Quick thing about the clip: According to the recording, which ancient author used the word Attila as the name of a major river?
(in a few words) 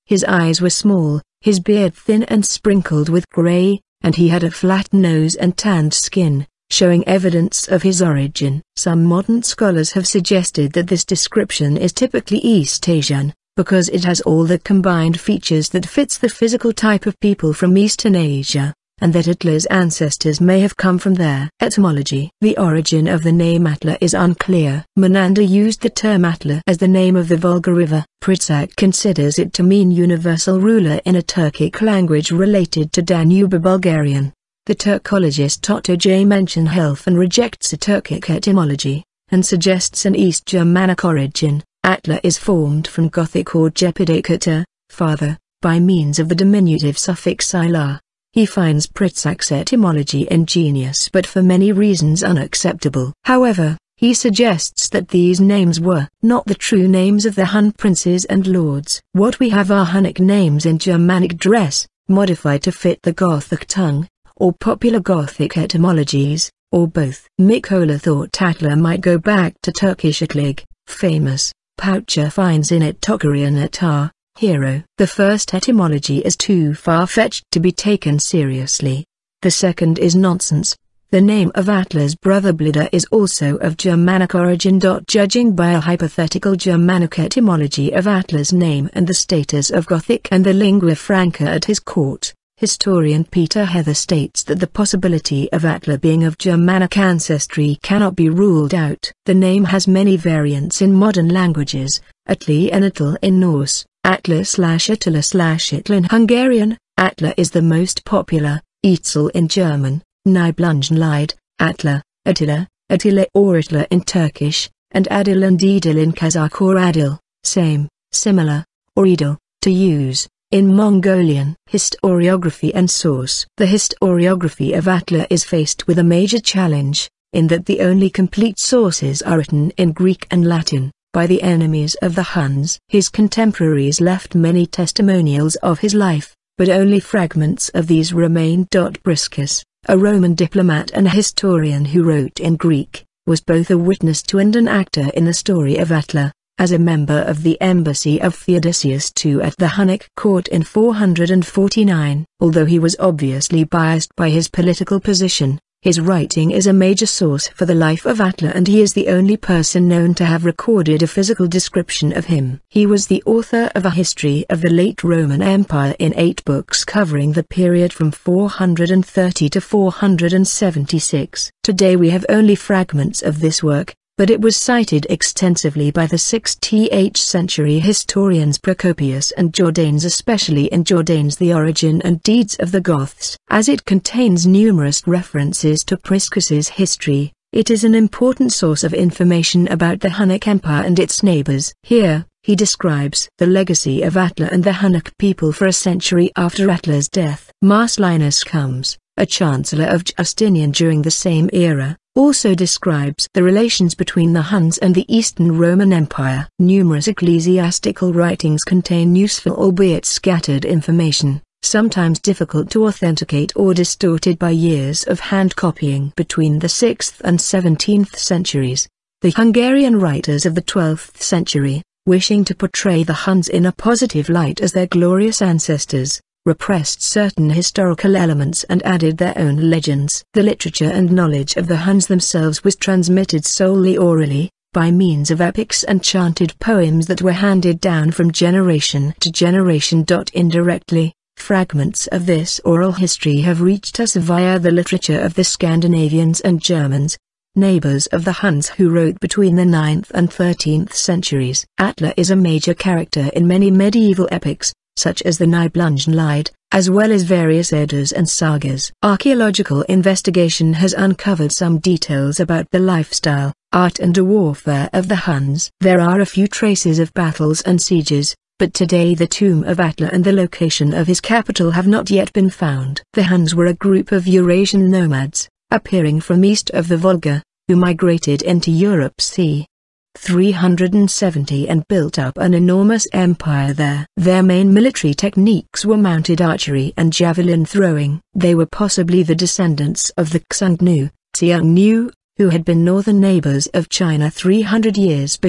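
Menander.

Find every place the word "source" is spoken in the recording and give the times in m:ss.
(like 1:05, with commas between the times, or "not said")
2:02, 2:08, 2:37, 3:08.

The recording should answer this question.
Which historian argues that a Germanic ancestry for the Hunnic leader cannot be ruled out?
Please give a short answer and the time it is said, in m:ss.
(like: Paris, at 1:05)
Peter Heather, at 1:33.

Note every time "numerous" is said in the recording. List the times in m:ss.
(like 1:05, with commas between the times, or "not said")
3:04, 3:26.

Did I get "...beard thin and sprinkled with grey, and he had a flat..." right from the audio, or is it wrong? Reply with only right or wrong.
right.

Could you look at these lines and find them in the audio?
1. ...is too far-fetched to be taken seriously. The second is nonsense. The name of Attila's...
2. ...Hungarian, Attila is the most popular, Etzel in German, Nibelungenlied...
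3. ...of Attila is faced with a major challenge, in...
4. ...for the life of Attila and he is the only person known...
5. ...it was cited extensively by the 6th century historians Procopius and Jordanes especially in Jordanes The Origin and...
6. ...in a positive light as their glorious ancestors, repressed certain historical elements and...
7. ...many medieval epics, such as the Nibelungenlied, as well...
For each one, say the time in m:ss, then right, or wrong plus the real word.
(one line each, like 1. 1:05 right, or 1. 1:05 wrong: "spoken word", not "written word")
1. 1:16 right
2. 1:45 right
3. 2:04 right
4. 2:37 right
5. 2:54 right
6. 3:43 right
7. 4:13 right.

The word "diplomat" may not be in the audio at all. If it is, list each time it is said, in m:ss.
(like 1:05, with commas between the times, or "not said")
2:20.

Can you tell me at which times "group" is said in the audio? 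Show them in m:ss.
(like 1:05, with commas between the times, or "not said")
4:33.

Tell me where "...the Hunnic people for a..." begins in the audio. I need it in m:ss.
3:14.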